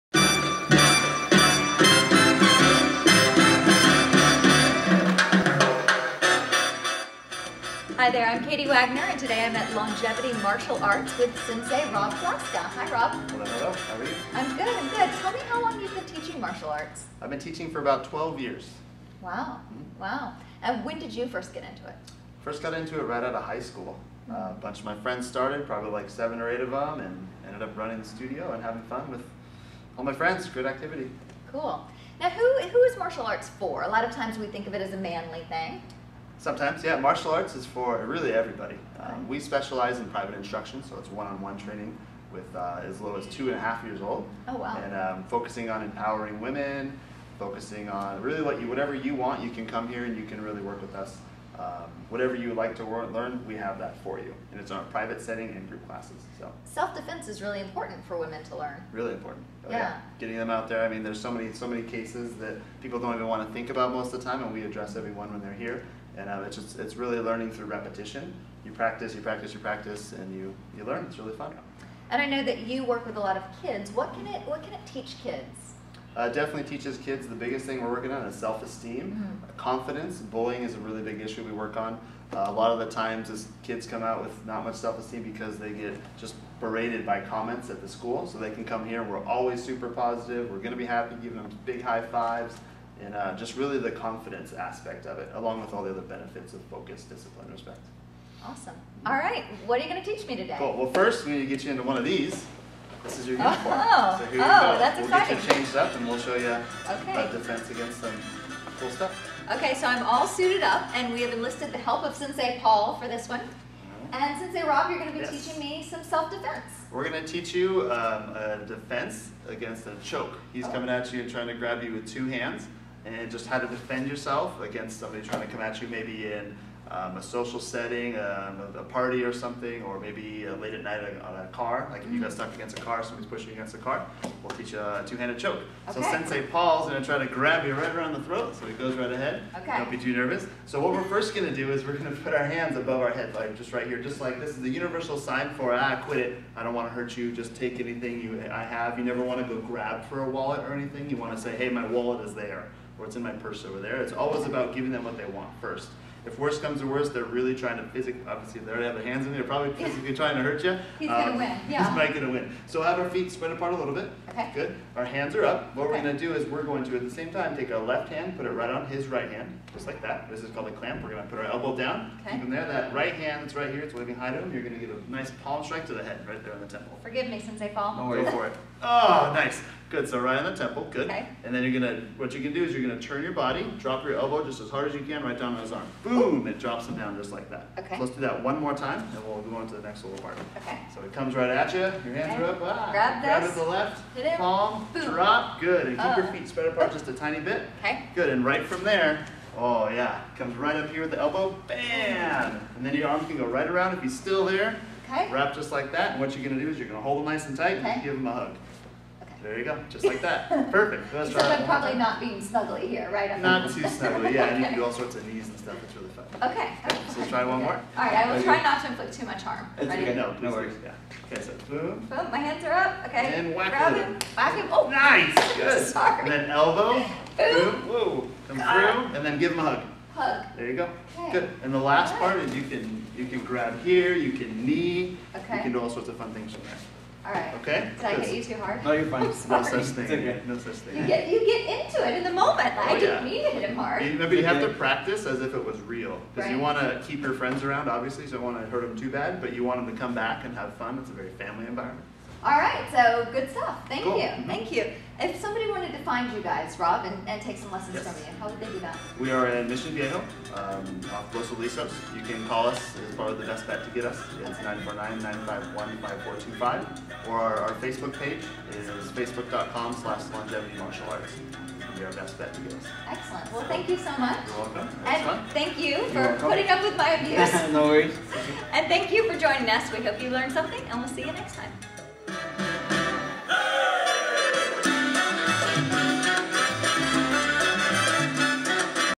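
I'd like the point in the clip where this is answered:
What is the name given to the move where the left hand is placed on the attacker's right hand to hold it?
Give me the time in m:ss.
2:50.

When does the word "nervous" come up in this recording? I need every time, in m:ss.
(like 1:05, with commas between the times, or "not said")
2:20.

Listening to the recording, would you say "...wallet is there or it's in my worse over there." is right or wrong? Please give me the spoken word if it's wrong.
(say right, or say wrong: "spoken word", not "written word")
wrong: "purse", not "worse".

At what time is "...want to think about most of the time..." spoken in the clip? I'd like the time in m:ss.
1:03.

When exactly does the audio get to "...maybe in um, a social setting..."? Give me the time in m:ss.
2:05.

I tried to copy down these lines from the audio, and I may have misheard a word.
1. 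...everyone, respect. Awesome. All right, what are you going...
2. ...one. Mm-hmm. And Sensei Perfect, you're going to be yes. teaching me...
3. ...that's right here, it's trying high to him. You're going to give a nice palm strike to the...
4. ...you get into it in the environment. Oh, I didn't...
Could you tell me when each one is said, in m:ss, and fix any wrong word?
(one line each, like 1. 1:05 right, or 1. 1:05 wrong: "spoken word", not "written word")
1. 1:37 wrong: "discipline", not "everyone"
2. 1:53 wrong: "Rob", not "Perfect"
3. 2:53 wrong: "waving", not "trying"
4. 4:01 wrong: "moment", not "environment".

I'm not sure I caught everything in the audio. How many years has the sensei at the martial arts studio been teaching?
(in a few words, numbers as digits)
12.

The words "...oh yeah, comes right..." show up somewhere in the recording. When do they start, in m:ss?
3:19.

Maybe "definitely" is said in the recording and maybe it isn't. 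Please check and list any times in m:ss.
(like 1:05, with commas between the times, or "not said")
1:16.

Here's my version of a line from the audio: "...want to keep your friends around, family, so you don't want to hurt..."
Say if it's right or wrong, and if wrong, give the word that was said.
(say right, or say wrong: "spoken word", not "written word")
wrong: "obviously", not "family".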